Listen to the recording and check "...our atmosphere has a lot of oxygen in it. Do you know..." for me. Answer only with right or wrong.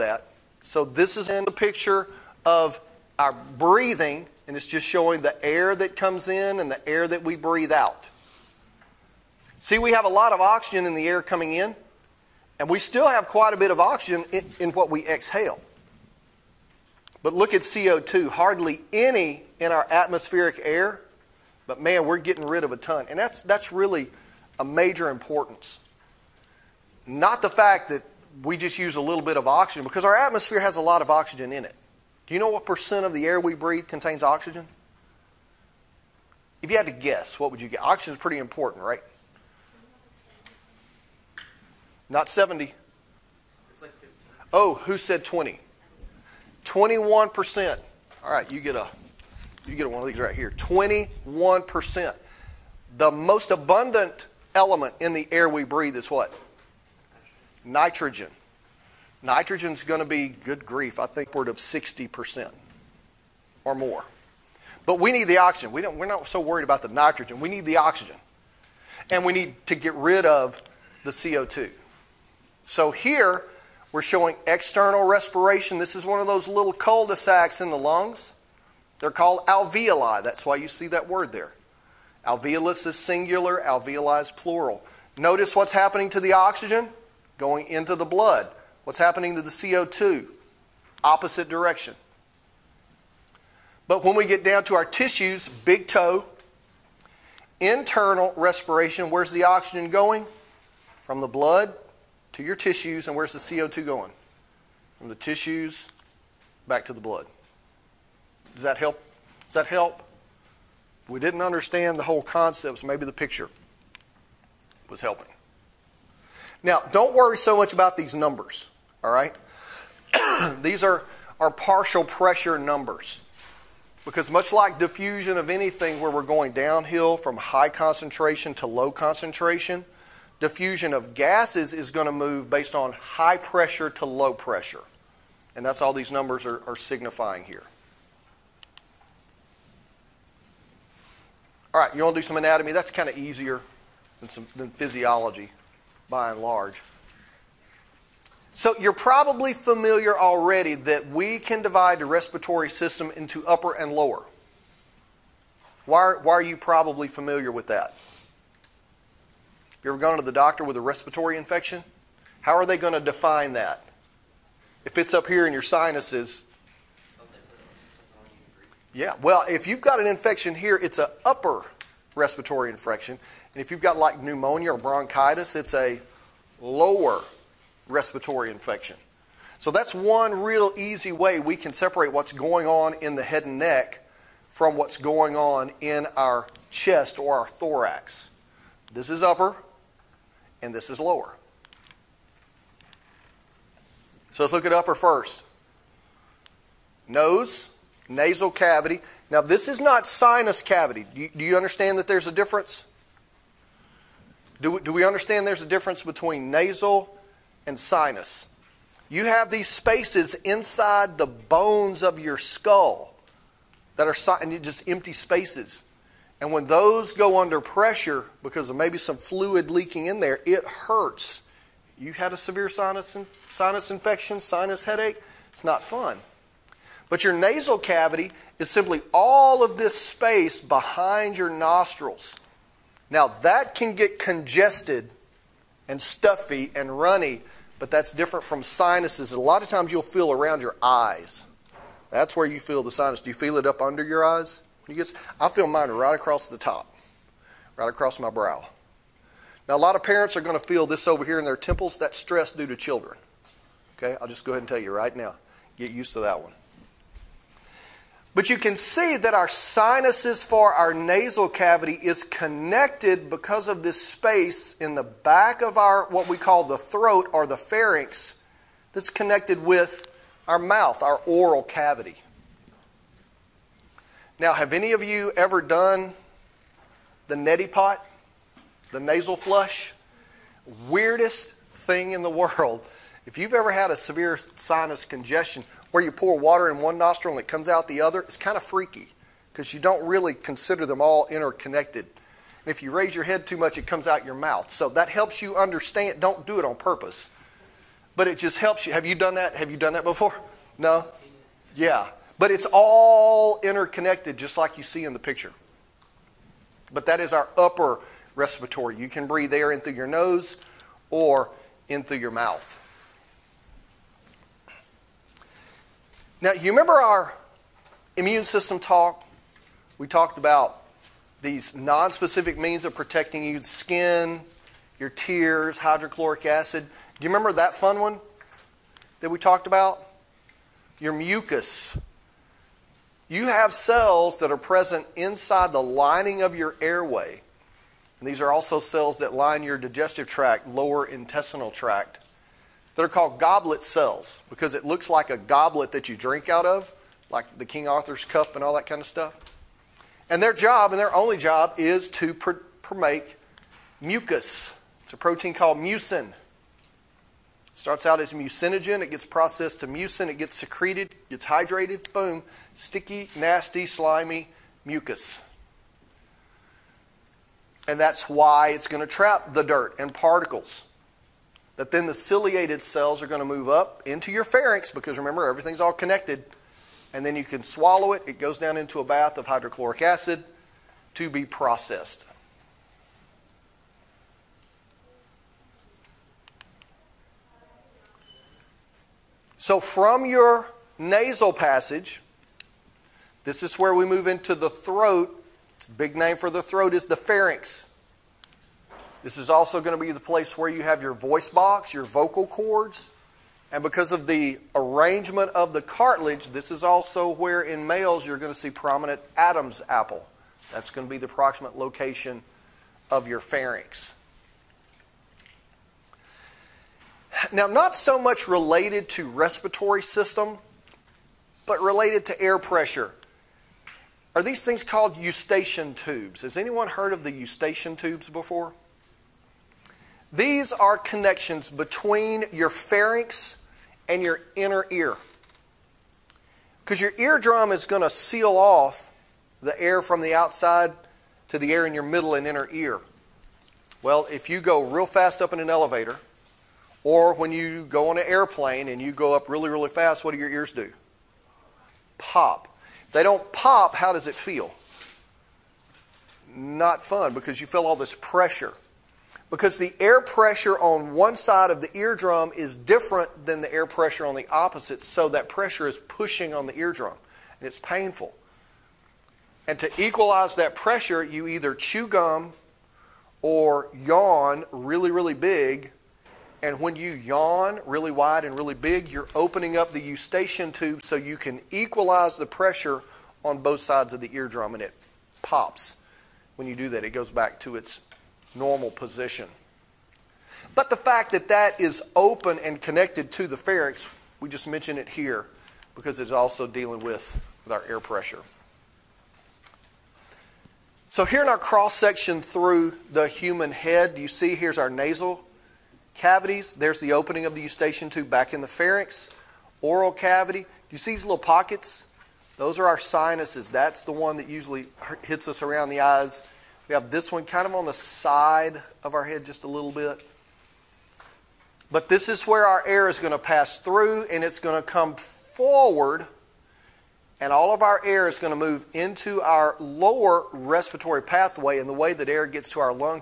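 right.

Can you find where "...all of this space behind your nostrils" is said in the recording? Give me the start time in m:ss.
3:49.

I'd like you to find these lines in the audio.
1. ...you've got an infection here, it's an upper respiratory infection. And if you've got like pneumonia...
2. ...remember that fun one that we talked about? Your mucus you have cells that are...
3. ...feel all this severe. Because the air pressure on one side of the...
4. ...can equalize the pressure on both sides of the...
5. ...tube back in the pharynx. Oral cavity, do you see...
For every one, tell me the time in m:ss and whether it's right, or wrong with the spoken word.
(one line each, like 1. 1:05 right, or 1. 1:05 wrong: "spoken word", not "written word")
1. 2:49 right
2. 5:27 right
3. 7:37 wrong: "pressure", not "severe"
4. 8:01 right
5. 8:28 right.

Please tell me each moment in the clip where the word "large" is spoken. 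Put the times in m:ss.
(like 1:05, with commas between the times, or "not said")
2:26.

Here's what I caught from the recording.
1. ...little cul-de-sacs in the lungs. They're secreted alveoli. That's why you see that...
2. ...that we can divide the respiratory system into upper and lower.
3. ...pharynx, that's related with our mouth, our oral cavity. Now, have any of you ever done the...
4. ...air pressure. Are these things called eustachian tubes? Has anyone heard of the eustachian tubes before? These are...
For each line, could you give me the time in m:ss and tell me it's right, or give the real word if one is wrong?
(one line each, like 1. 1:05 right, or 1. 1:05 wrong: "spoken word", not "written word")
1. 1:16 wrong: "called", not "secreted"
2. 2:30 right
3. 4:27 wrong: "connected", not "related"
4. 7:02 right.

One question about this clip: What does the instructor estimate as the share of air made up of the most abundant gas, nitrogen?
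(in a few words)
60% or more.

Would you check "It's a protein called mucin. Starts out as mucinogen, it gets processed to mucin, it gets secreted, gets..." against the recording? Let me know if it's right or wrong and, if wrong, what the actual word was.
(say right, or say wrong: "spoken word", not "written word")
right.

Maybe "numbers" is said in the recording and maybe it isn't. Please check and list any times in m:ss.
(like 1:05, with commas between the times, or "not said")
1:58, 2:02, 2:16.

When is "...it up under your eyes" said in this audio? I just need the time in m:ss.
4:03.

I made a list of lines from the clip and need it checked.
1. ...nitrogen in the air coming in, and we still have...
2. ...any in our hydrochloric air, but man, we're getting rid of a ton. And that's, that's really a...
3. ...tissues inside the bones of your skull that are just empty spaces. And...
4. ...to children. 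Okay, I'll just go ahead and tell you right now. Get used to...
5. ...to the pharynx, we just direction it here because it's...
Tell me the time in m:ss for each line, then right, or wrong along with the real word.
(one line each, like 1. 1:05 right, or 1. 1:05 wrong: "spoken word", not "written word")
1. 0:10 wrong: "oxygen", not "nitrogen"
2. 0:18 wrong: "atmospheric", not "hydrochloric"
3. 3:29 wrong: "spaces", not "tissues"
4. 4:12 right
5. 8:13 wrong: "mention", not "direction".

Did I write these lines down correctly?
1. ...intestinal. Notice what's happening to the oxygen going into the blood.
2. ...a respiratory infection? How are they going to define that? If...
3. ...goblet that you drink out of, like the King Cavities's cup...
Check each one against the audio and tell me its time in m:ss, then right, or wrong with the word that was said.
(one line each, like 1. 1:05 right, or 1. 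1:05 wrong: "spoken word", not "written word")
1. 1:24 wrong: "plural", not "intestinal"
2. 2:40 right
3. 5:45 wrong: "Arthur", not "Cavities".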